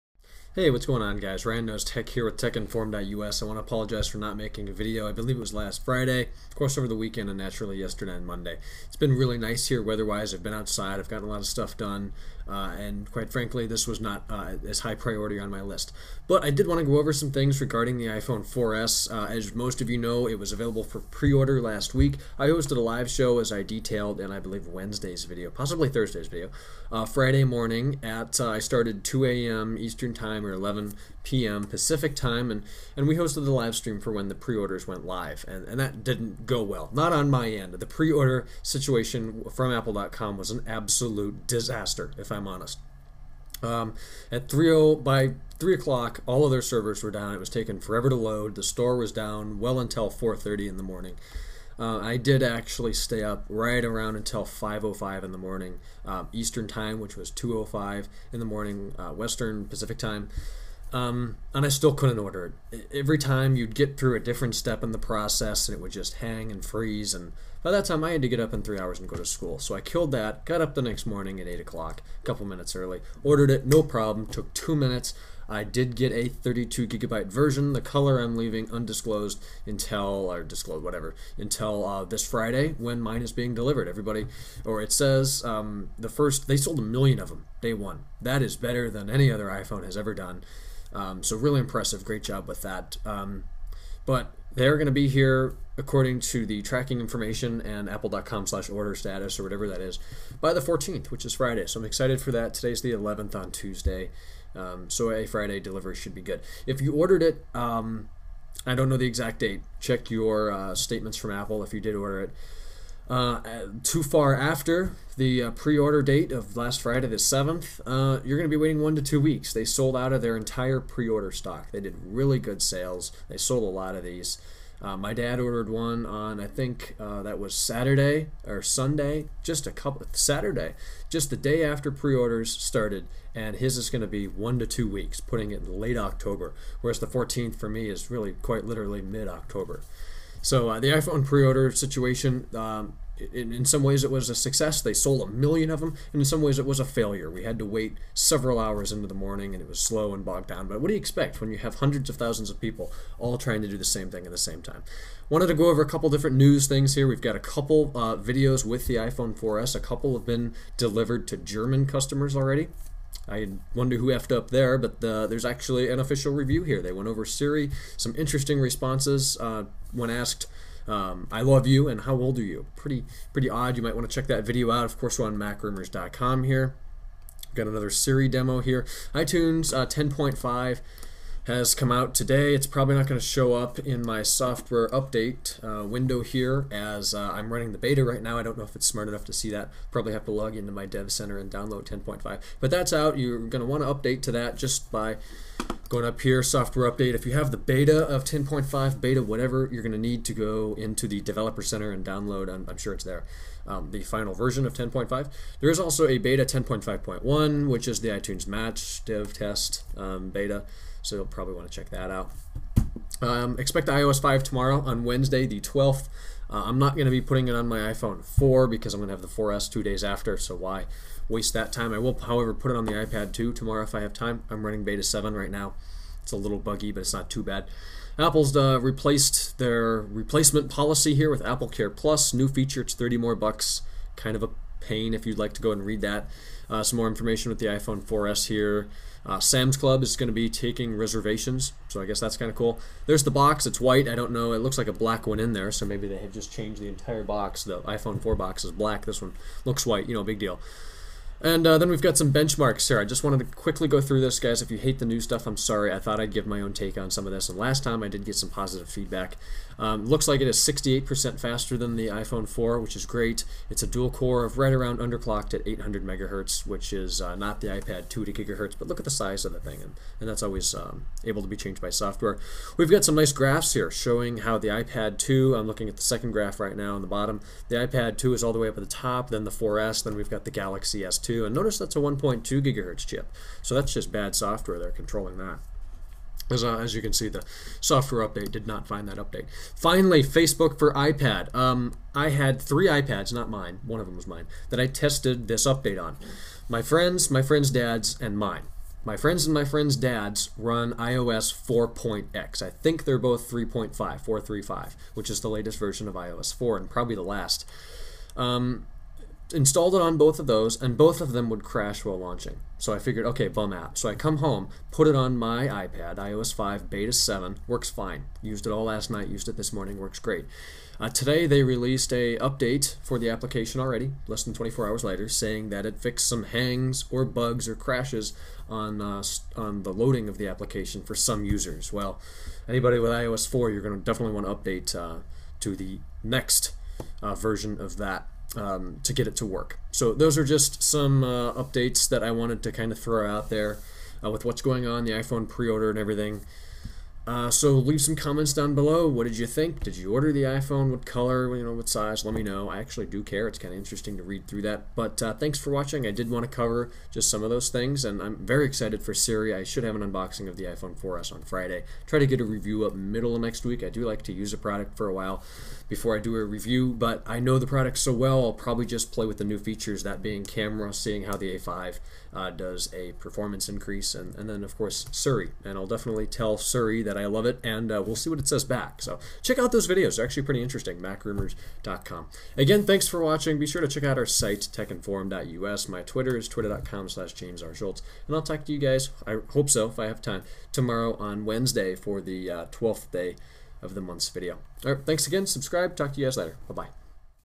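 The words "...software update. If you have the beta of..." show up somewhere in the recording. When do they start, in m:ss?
3:16.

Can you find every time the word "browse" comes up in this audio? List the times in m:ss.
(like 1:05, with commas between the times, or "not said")
not said.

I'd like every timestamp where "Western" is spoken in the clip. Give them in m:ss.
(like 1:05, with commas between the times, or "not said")
0:59.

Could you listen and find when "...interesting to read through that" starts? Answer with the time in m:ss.
5:53.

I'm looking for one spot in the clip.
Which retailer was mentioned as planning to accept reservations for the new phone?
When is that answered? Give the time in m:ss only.
3:59.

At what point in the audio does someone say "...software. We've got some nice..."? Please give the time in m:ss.
4:31.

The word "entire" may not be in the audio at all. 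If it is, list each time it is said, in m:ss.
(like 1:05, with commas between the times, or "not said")
2:00, 4:06.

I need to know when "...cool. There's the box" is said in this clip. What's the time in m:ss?
4:02.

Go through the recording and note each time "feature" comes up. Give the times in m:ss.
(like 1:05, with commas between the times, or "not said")
3:52, 6:09.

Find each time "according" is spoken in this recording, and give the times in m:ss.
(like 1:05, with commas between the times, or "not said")
1:35.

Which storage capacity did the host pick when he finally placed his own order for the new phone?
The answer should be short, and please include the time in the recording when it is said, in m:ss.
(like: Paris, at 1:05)
32 GB, at 1:16.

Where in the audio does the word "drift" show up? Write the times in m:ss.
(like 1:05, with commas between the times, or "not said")
not said.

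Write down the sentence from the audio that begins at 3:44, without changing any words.
I'm running beta 7 right now.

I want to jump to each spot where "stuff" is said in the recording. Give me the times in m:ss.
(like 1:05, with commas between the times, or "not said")
0:11, 4:15.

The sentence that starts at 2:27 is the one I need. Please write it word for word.
We had to wait several hours into the morning, and it was slow and bogged down.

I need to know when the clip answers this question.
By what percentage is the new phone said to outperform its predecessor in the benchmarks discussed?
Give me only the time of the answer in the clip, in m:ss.
4:20.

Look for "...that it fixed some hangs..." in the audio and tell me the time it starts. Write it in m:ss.
5:25.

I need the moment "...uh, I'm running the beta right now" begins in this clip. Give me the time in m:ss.
3:07.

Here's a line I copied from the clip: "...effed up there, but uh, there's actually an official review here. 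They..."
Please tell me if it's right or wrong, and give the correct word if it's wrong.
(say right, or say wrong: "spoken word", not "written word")
right.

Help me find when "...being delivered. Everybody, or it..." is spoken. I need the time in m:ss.
1:23.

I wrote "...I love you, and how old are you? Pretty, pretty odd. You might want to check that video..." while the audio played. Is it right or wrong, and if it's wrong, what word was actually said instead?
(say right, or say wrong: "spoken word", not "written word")
right.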